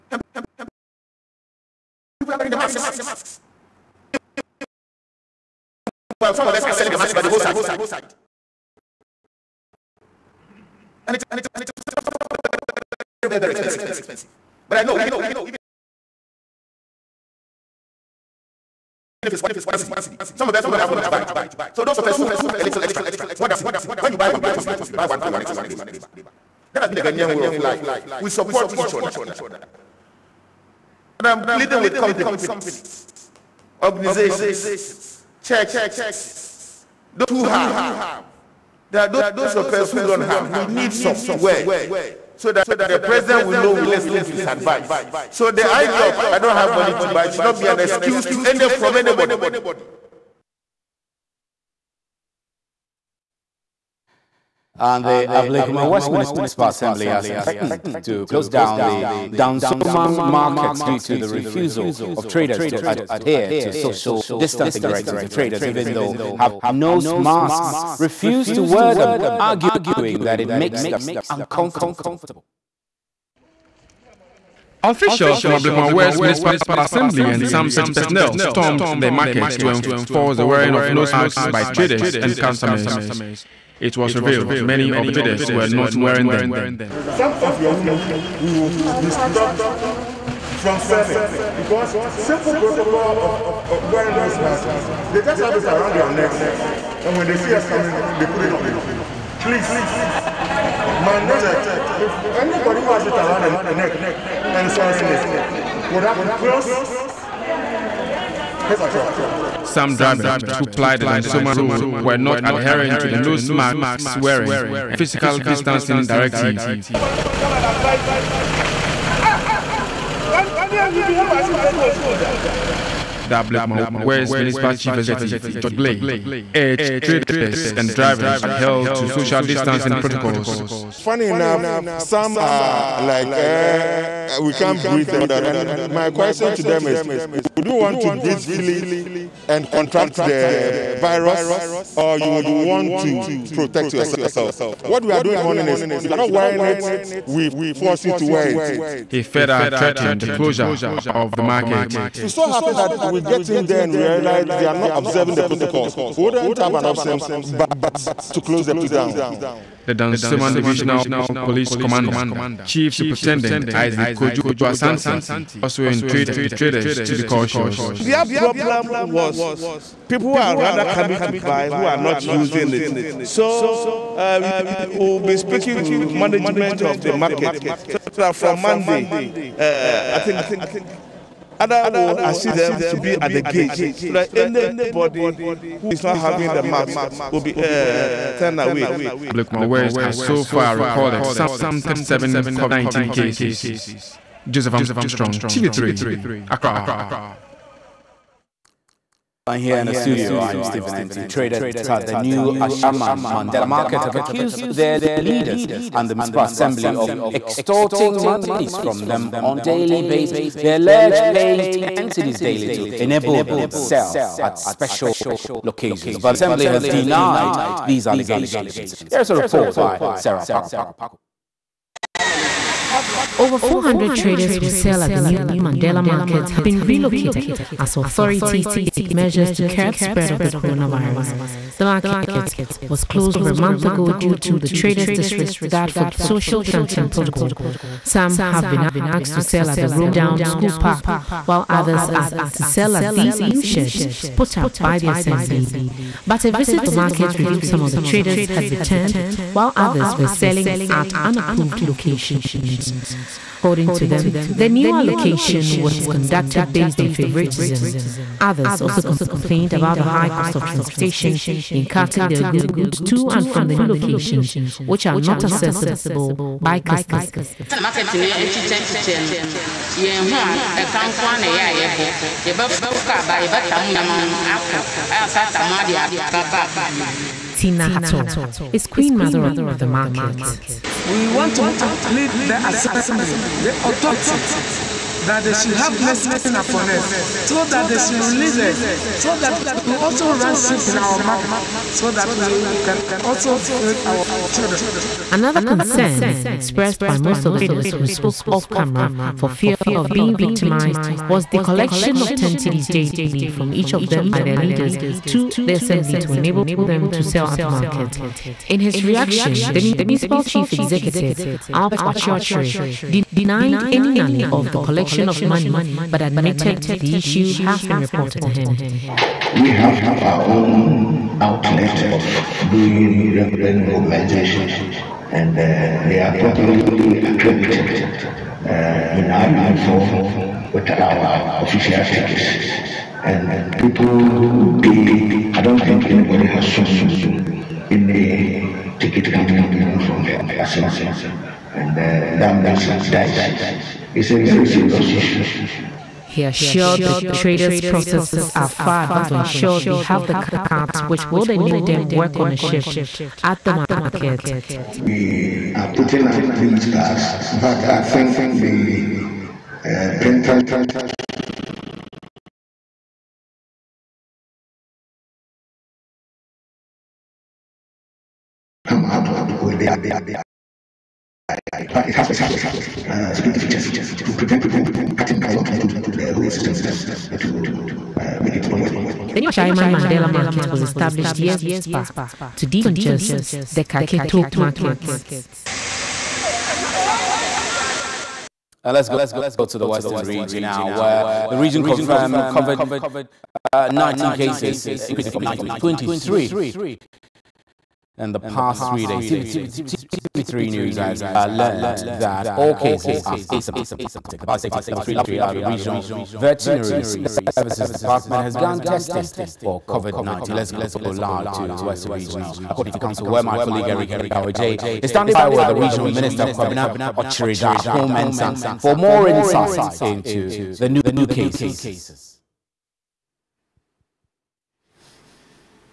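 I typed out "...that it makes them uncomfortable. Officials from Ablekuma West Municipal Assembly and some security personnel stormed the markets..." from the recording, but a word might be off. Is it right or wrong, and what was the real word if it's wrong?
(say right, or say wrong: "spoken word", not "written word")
right.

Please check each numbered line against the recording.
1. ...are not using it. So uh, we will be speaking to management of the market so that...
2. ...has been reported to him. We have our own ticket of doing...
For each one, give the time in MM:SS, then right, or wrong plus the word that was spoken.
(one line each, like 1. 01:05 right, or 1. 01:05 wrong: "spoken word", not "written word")
1. 02:51 right
2. 05:17 wrong: "outlet", not "ticket".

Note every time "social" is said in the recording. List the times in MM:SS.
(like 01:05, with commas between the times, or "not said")
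01:03, 02:09, 03:56.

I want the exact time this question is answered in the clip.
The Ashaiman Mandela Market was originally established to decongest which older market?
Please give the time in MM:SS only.
06:23.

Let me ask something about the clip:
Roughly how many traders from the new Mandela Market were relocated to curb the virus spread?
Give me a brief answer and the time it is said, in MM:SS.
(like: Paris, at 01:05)
400, at 03:43.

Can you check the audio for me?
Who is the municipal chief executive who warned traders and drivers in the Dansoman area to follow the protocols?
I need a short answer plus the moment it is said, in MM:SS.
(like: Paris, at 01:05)
George Blay, at 02:05.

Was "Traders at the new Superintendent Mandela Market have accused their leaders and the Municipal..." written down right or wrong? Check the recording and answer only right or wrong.
wrong.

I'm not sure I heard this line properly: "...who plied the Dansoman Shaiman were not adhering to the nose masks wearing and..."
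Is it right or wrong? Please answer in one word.
wrong.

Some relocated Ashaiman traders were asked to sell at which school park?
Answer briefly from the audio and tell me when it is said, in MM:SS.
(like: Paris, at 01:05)
Rome Down School Park, at 03:59.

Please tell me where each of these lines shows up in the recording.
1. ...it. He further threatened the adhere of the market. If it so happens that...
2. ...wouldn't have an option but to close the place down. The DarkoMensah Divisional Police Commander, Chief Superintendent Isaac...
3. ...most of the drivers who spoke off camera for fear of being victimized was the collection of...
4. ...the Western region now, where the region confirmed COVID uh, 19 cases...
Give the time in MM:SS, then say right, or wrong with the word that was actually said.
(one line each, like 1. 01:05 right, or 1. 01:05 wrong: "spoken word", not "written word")
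1. 02:28 wrong: "closure", not "adhere"
2. 02:36 wrong: "Dansoman", not "DarkoMensah"
3. 04:57 wrong: "traders", not "drivers"
4. 06:29 right.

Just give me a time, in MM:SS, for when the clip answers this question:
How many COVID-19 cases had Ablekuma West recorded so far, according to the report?
03:11.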